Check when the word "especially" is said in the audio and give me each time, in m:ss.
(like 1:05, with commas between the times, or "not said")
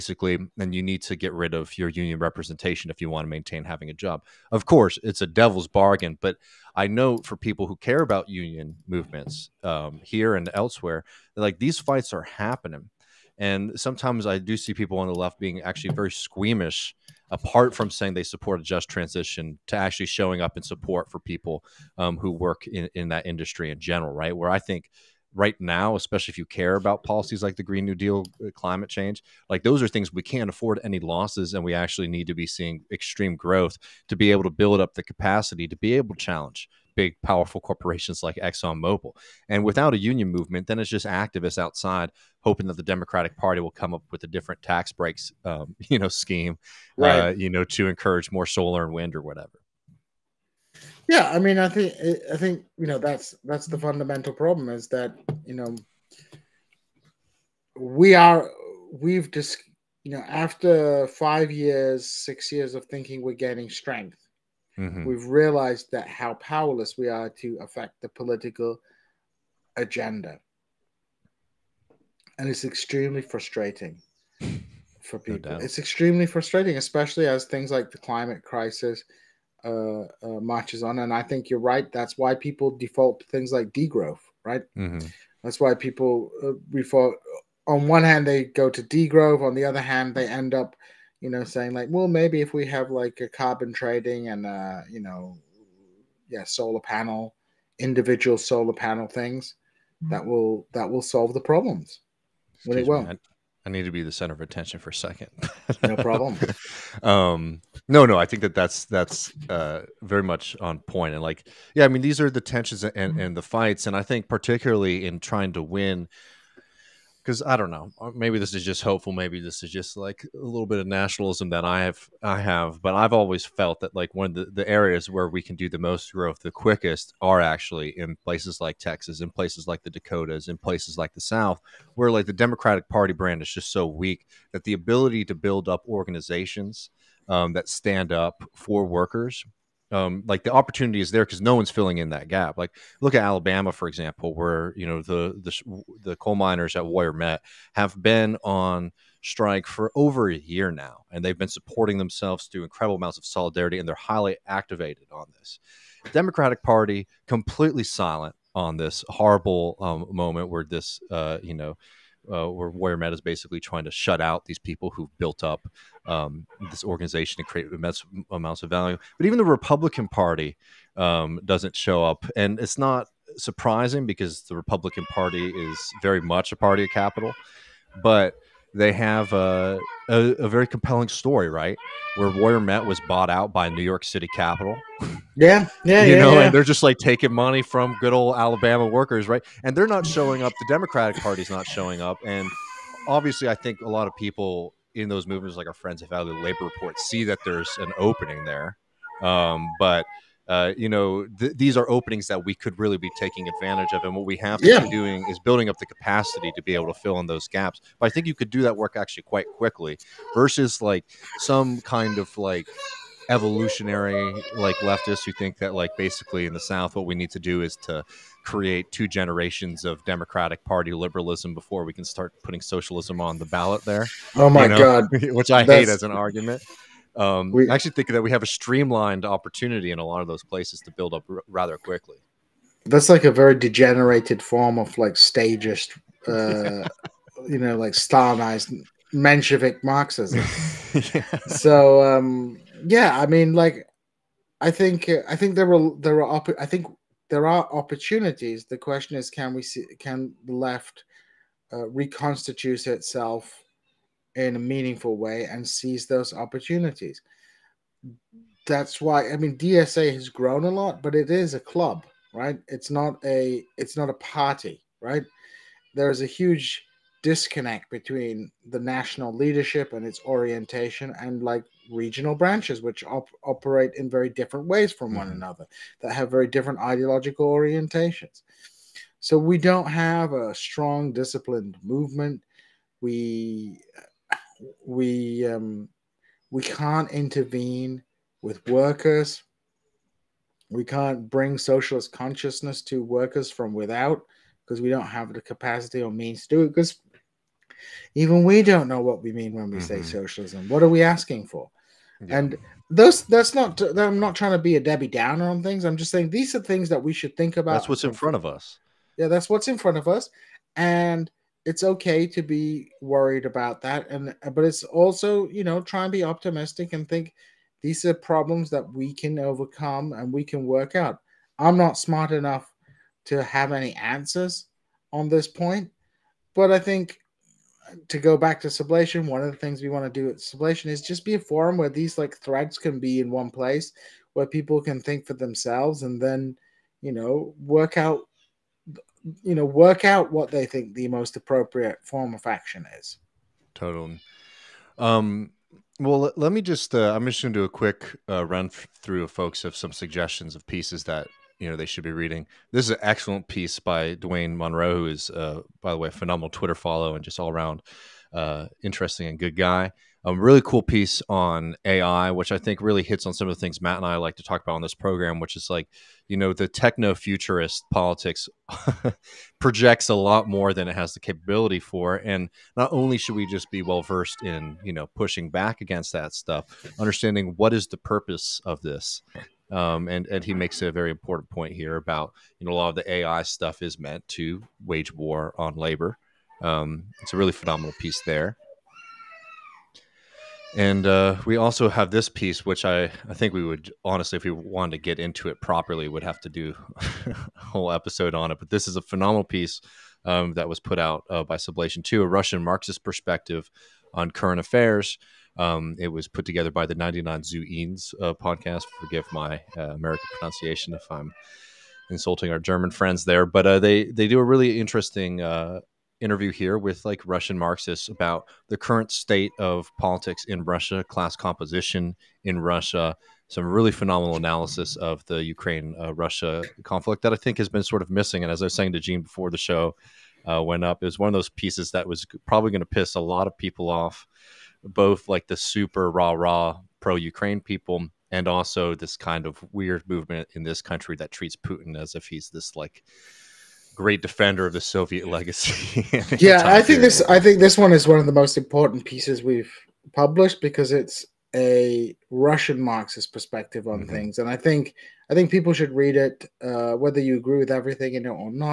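0:25, 1:16.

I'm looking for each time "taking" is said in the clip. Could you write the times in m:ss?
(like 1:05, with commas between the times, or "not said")
3:06, 3:23.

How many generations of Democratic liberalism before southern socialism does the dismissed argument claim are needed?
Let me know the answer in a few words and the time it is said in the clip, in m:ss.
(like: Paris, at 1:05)
2, at 3:38.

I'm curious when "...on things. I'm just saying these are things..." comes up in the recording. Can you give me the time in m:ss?
5:05.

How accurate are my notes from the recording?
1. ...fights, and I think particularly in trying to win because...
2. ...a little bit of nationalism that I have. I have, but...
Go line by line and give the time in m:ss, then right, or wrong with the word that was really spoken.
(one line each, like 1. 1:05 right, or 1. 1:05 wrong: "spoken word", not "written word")
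1. 1:53 right
2. 2:00 right.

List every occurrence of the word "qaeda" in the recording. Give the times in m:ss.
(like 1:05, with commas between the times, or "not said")
not said.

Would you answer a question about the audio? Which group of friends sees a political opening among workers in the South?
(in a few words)
Valley Labor Report.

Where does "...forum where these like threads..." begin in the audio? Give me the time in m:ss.
5:31.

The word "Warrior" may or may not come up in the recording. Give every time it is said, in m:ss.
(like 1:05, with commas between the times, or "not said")
2:26, 2:42, 3:02.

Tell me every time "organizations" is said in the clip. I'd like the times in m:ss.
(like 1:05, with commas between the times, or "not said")
2:15, 2:46.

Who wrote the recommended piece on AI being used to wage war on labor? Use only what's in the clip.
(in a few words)
Dwayne Monroe.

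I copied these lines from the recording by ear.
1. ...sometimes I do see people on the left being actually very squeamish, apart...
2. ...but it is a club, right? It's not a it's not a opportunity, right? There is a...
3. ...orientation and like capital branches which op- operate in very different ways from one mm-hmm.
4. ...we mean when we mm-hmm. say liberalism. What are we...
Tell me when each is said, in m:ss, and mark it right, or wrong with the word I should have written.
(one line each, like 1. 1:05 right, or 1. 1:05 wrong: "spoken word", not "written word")
1. 0:13 right
2. 4:21 wrong: "party", not "opportunity"
3. 4:30 wrong: "regional", not "capital"
4. 4:59 wrong: "socialism", not "liberalism".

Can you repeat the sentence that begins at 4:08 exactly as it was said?
The question is, can we see can the left uh, reconstitute itself?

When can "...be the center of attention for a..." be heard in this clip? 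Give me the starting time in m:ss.
1:43.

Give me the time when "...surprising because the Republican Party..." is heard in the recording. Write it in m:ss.
2:53.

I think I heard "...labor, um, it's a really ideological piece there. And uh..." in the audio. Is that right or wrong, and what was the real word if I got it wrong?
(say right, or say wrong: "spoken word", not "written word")
wrong: "phenomenal", not "ideological".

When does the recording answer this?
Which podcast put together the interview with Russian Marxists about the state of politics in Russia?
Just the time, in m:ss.
6:46.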